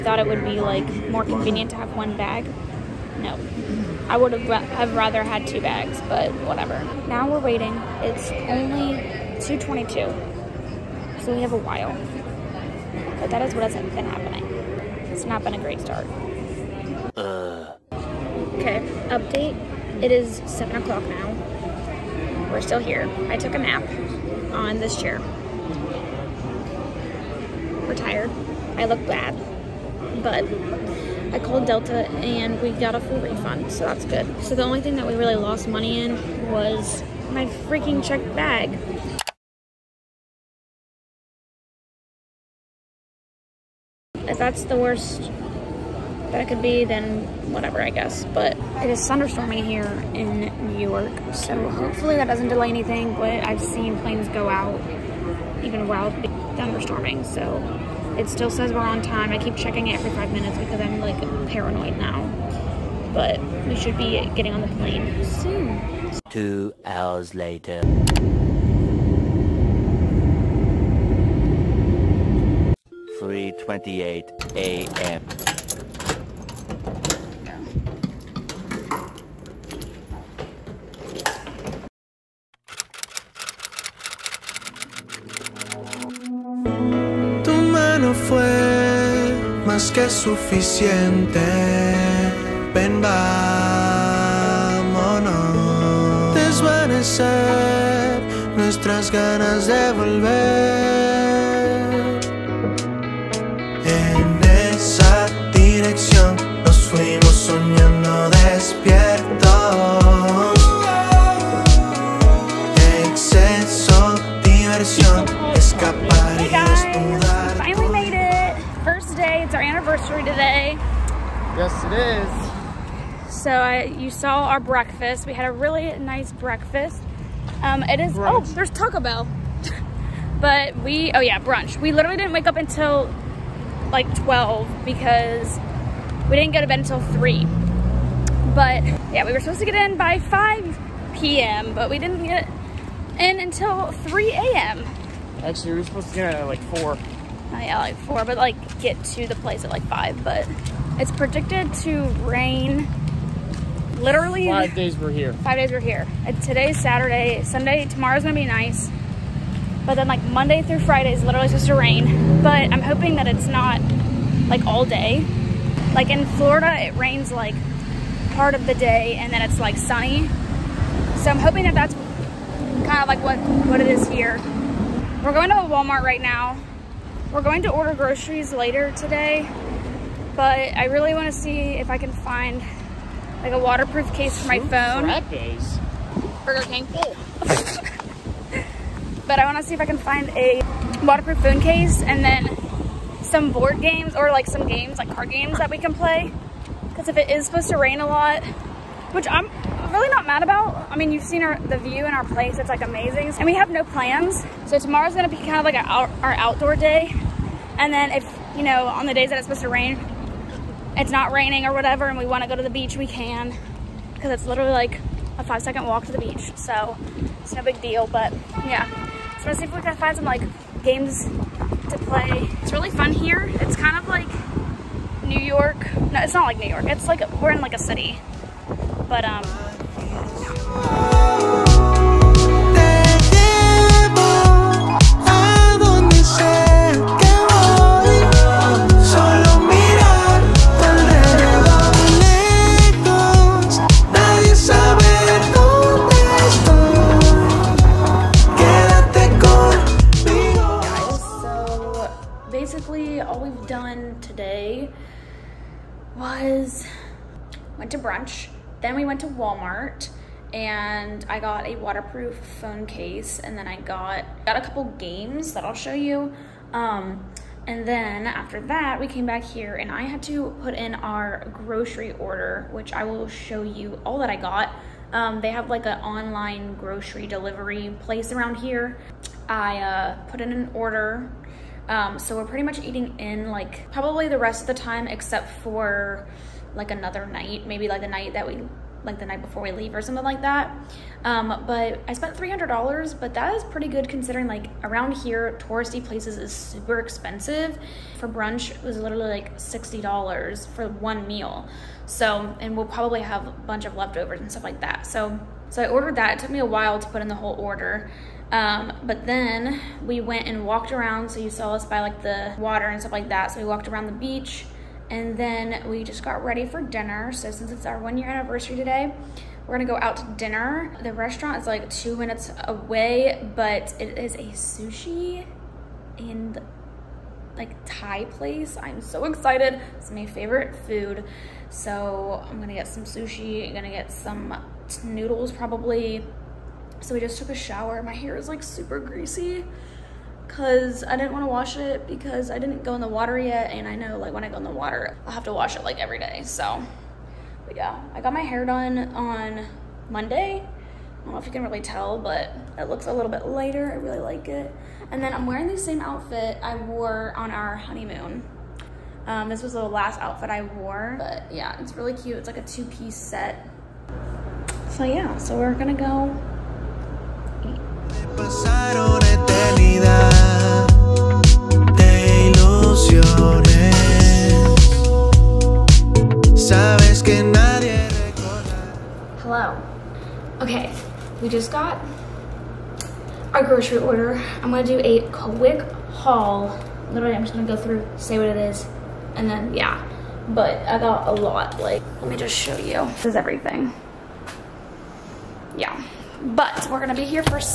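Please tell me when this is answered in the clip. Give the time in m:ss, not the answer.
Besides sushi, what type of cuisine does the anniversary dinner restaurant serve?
5:27.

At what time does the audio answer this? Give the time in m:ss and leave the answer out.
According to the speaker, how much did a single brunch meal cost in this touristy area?
4:59.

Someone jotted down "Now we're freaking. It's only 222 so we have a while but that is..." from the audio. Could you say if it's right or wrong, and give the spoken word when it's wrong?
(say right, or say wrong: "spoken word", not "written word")
wrong: "waiting", not "freaking".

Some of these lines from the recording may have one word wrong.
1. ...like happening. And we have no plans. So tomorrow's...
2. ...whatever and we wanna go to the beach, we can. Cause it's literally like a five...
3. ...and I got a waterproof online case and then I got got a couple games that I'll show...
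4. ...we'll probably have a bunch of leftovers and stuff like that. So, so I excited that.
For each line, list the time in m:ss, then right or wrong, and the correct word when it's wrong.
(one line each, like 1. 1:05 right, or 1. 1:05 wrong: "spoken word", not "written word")
1. 3:22 wrong: "amazing", not "happening"
2. 3:31 right
3. 4:20 wrong: "phone", not "online"
4. 5:02 wrong: "ordered", not "excited".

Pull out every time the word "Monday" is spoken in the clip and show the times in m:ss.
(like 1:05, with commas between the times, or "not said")
2:40, 5:50.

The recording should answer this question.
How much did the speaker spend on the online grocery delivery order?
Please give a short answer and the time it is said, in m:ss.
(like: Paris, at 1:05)
$300, at 4:52.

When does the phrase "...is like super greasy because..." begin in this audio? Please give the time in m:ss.
5:38.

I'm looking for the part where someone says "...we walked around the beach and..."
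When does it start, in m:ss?
5:13.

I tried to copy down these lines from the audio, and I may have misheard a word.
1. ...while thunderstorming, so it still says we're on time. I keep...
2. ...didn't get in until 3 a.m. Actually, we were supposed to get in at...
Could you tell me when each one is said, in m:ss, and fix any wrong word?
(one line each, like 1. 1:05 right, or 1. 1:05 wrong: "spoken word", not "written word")
1. 0:55 right
2. 2:21 right.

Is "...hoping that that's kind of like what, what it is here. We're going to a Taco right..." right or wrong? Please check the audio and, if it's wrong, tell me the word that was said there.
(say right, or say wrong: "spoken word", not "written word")
wrong: "Walmart", not "Taco".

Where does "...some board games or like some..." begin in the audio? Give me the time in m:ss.
3:13.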